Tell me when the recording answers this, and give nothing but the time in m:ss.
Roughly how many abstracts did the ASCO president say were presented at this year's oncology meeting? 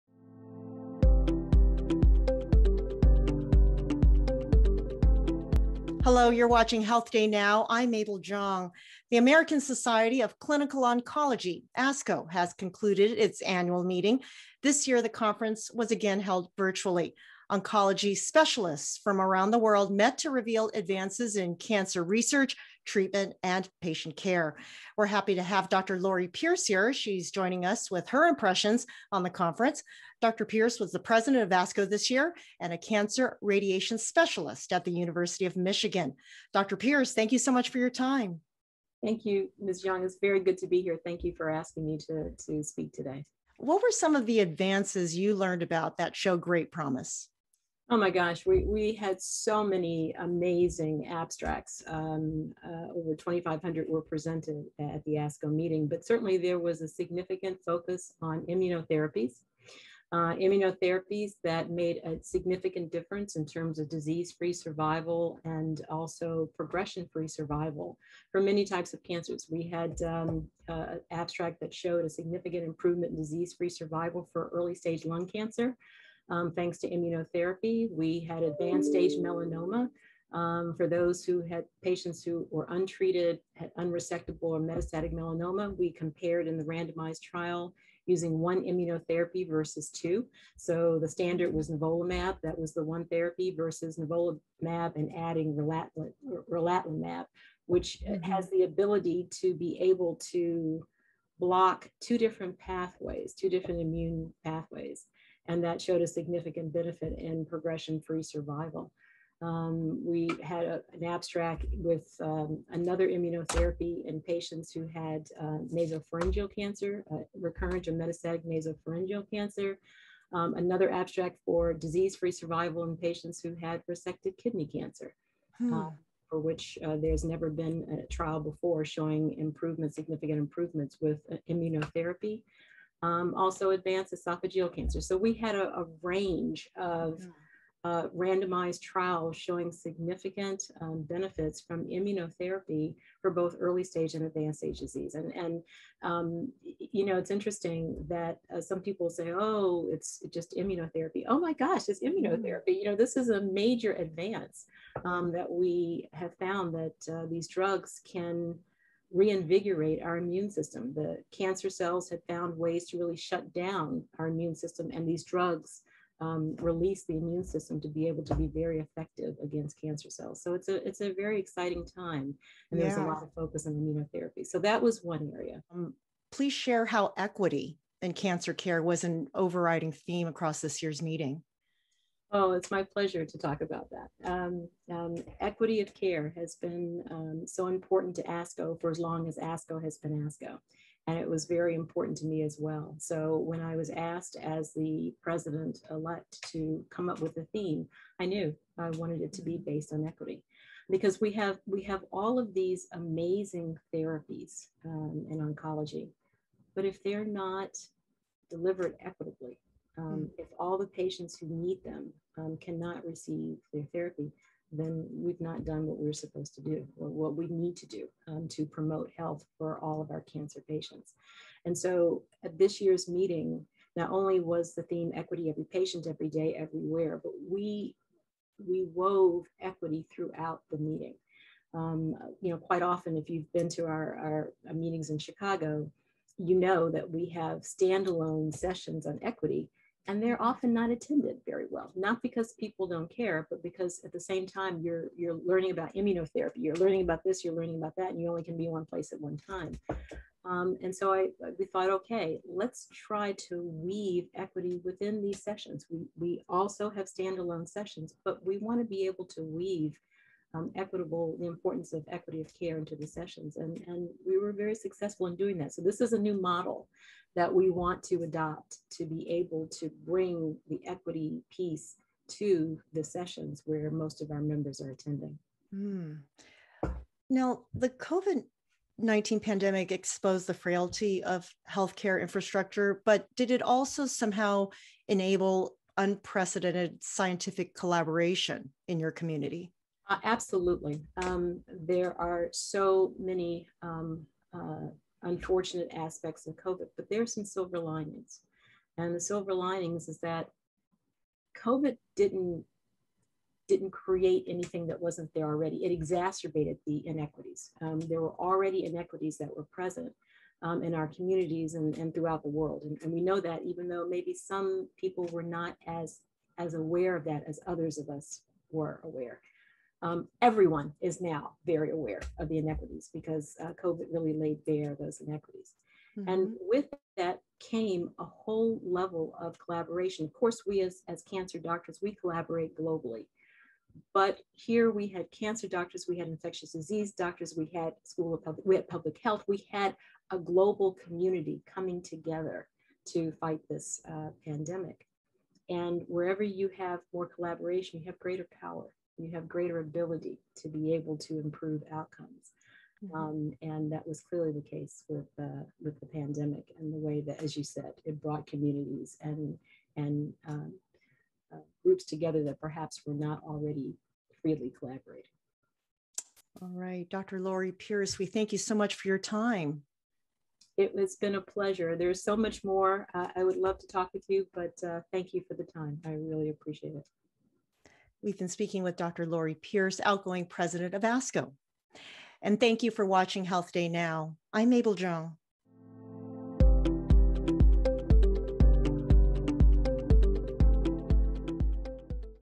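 0:52.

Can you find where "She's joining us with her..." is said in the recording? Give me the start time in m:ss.
0:26.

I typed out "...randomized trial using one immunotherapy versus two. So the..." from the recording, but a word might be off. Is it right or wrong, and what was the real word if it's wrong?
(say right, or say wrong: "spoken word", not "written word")
right.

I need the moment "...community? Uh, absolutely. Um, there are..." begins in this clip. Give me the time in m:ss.
4:49.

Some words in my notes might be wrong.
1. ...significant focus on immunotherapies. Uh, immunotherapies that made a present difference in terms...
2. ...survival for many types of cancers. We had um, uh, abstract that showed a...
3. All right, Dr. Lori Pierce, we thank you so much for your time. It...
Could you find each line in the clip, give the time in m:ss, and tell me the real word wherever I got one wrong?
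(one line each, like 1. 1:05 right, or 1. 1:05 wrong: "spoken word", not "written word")
1. 0:56 wrong: "significant", not "present"
2. 1:07 right
3. 6:06 right.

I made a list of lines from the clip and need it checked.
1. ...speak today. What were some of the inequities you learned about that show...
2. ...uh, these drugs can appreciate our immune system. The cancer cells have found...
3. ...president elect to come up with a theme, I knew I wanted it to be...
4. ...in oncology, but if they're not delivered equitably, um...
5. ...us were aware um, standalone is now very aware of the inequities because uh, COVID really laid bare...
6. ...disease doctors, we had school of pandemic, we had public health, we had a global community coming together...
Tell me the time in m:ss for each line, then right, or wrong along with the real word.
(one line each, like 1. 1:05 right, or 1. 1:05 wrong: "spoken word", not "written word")
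1. 0:42 wrong: "advances", not "inequities"
2. 2:37 wrong: "reinvigorate", not "appreciate"
3. 3:15 right
4. 3:25 right
5. 5:18 wrong: "everyone", not "standalone"
6. 5:36 wrong: "public", not "pandemic".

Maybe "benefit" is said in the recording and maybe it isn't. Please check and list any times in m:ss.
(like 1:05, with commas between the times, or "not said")
1:46, 2:21.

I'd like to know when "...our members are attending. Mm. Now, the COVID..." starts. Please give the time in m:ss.
4:34.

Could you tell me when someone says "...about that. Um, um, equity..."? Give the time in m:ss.
3:03.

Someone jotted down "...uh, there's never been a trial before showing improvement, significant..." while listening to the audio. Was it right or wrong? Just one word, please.
right.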